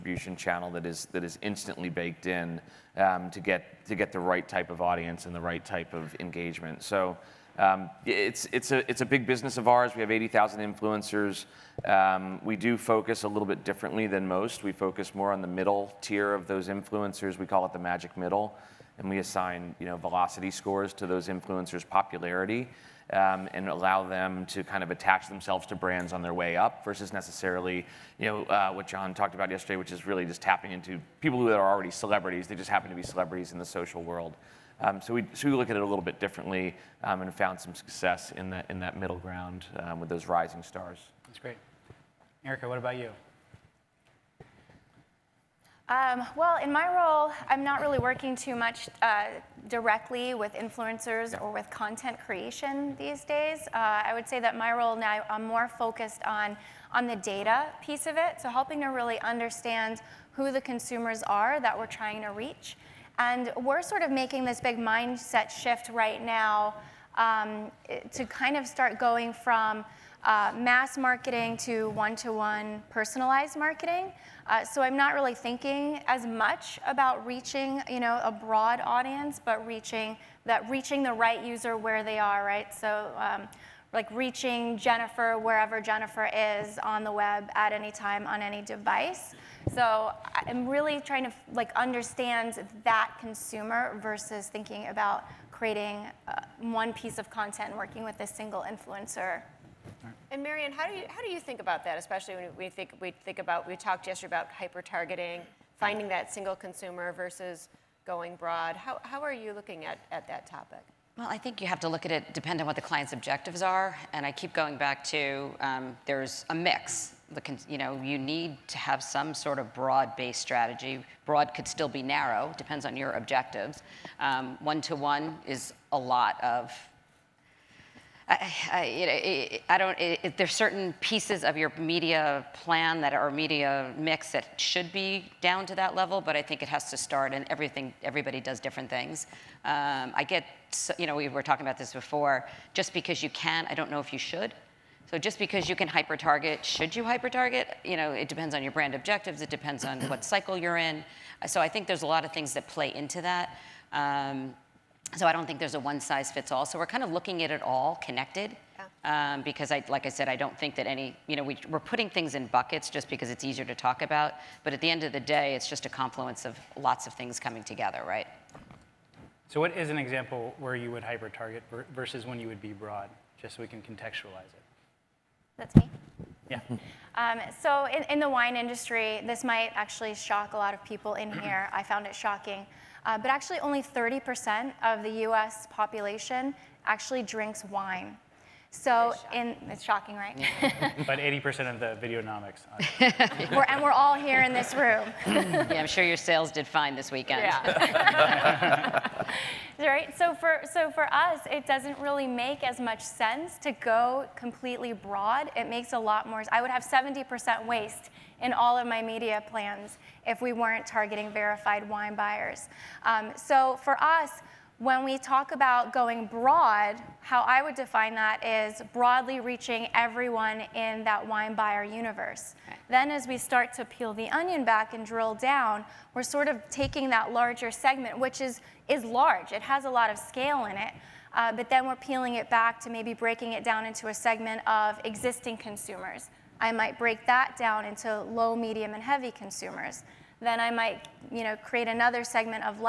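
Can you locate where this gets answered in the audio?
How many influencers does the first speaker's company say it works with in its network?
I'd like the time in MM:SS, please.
00:10.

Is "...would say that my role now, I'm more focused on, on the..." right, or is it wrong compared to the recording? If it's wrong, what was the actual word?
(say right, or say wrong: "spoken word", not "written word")
right.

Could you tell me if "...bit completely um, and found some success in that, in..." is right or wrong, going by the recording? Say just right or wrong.
wrong.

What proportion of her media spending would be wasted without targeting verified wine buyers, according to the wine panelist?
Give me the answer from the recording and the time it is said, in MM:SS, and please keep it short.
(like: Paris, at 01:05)
70%, at 03:26.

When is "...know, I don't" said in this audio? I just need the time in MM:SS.
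02:09.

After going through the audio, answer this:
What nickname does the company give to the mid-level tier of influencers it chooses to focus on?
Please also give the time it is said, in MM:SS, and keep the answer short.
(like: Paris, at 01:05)
The magic middle, at 00:17.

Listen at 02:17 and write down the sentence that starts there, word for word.
And everything, everybody does different things.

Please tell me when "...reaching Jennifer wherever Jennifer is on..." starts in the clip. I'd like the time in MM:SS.
01:24.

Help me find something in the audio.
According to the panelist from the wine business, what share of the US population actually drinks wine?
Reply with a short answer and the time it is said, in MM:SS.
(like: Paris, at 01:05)
30%, at 03:03.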